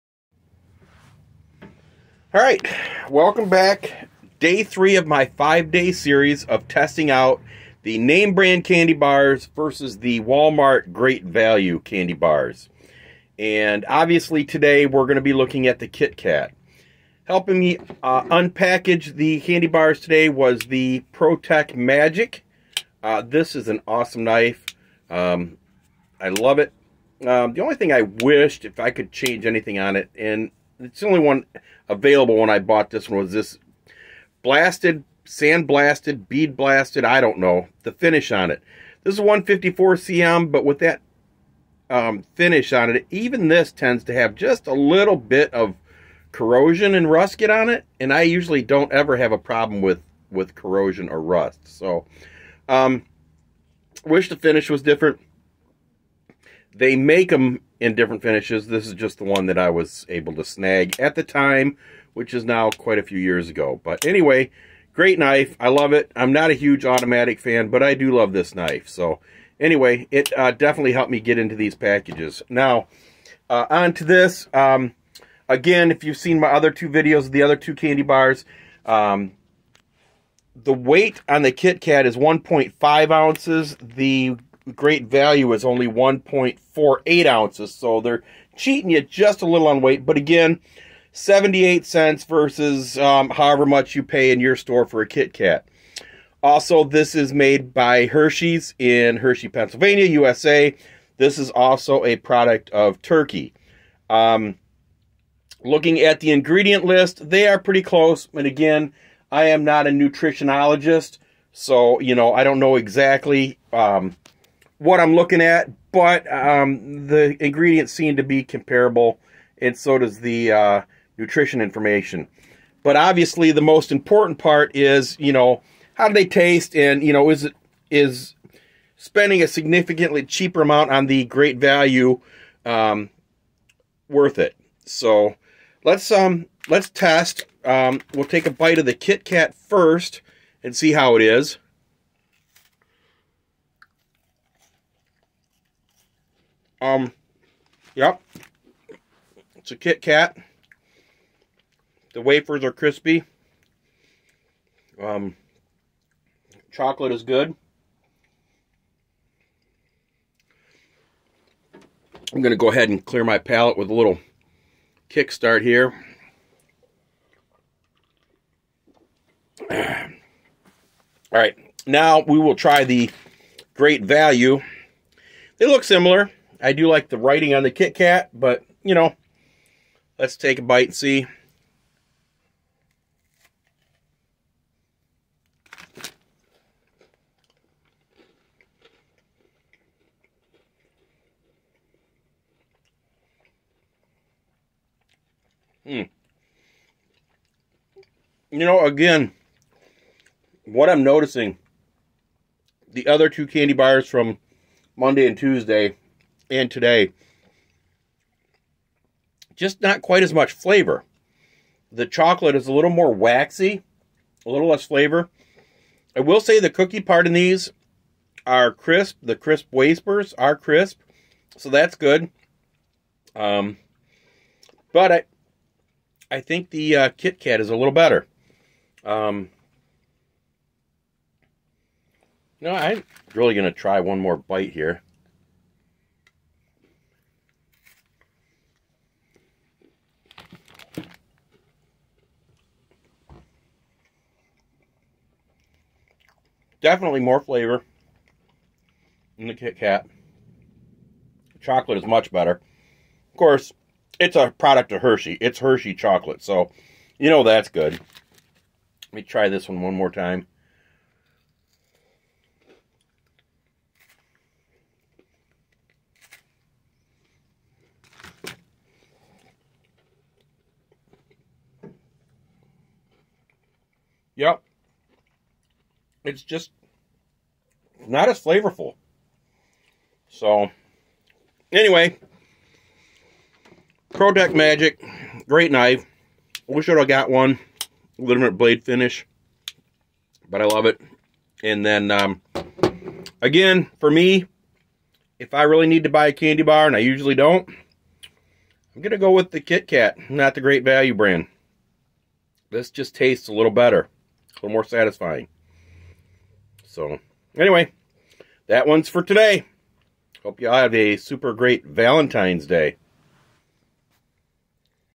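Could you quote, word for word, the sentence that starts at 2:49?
All right, now we will try the Great Value.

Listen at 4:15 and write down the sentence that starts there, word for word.
It's Hershey chocolate, so you know that's good.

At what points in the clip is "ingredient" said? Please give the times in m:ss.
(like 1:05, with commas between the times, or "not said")
1:46, 1:57.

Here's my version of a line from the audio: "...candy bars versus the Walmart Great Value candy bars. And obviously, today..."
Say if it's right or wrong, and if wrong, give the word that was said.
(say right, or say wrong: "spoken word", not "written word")
right.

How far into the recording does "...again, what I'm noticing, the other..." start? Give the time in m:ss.
3:18.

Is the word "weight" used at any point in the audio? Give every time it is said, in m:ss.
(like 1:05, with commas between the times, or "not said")
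1:20, 1:29.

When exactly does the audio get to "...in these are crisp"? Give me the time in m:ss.
3:37.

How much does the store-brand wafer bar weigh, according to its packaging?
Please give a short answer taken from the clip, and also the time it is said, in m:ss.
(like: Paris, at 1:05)
1.48 ounces, at 1:25.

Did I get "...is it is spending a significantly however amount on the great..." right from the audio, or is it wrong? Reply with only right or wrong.
wrong.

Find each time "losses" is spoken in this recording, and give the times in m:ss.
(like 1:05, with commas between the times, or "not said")
not said.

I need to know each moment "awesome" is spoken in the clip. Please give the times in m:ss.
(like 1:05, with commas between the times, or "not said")
0:23.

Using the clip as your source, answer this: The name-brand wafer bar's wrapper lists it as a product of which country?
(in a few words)
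Turkey.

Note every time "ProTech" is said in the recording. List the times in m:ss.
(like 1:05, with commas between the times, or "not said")
0:21, 4:44.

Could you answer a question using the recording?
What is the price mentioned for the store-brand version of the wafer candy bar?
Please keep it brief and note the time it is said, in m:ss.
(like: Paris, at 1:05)
78 cents, at 1:31.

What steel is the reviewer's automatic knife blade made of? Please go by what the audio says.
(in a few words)
154 CM.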